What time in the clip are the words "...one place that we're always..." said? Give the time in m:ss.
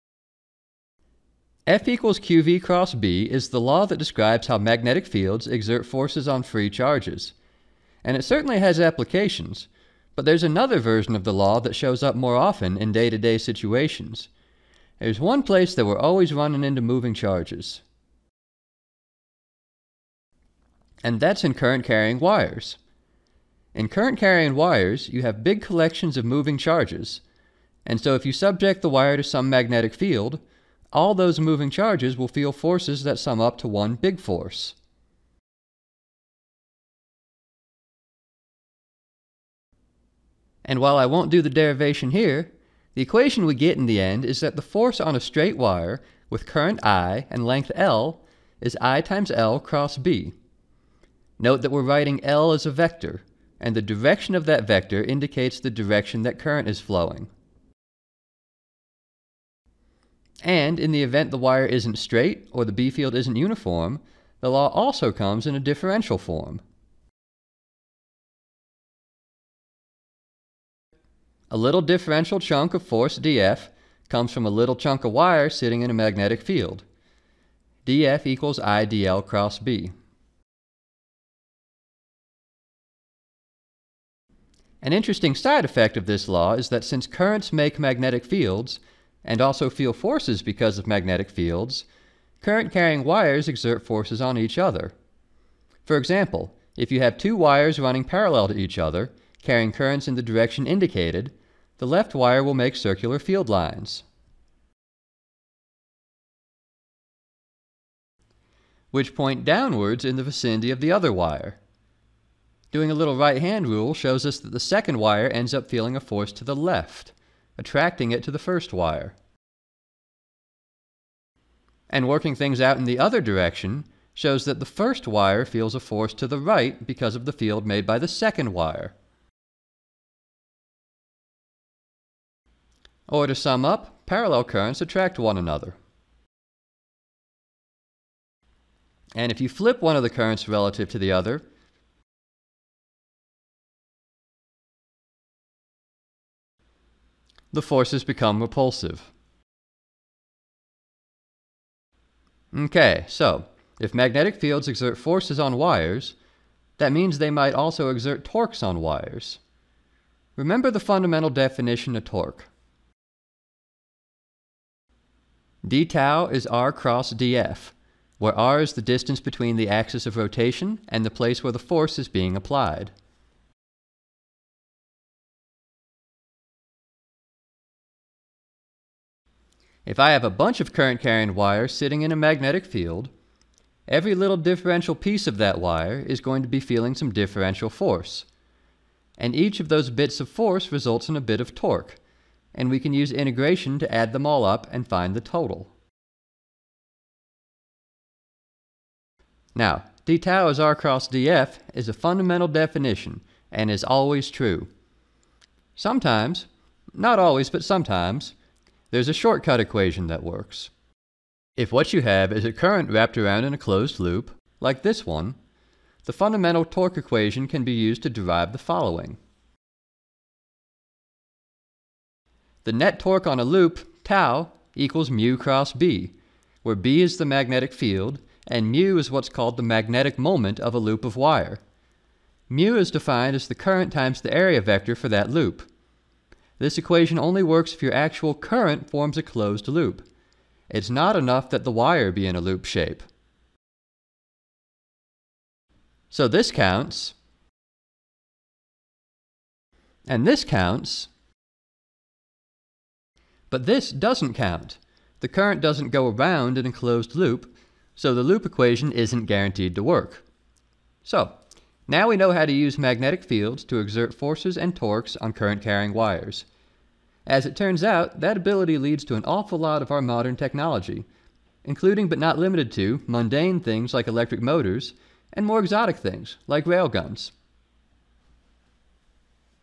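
0:15.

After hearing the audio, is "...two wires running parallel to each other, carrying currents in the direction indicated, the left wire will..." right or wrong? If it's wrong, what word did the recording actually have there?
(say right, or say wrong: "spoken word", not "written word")
right.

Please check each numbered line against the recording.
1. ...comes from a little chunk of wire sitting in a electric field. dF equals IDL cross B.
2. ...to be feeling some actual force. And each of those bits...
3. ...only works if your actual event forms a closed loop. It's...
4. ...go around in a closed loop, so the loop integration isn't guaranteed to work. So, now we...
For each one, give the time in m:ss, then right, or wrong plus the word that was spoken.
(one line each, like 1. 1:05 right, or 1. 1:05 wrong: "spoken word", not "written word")
1. 1:14 wrong: "magnetic", not "electric"
2. 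3:06 wrong: "differential", not "actual"
3. 3:57 wrong: "current", not "event"
4. 4:15 wrong: "equation", not "integration".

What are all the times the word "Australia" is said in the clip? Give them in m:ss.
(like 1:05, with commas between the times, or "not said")
not said.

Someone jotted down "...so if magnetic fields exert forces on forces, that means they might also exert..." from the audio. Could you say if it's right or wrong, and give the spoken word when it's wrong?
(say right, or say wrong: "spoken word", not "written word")
wrong: "wires", not "forces".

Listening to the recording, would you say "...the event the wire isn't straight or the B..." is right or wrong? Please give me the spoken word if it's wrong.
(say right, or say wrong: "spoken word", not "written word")
right.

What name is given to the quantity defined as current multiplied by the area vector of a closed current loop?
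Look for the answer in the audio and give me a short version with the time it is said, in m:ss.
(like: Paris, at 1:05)
Magnetic moment, at 3:49.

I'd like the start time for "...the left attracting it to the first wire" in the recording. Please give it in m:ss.
1:56.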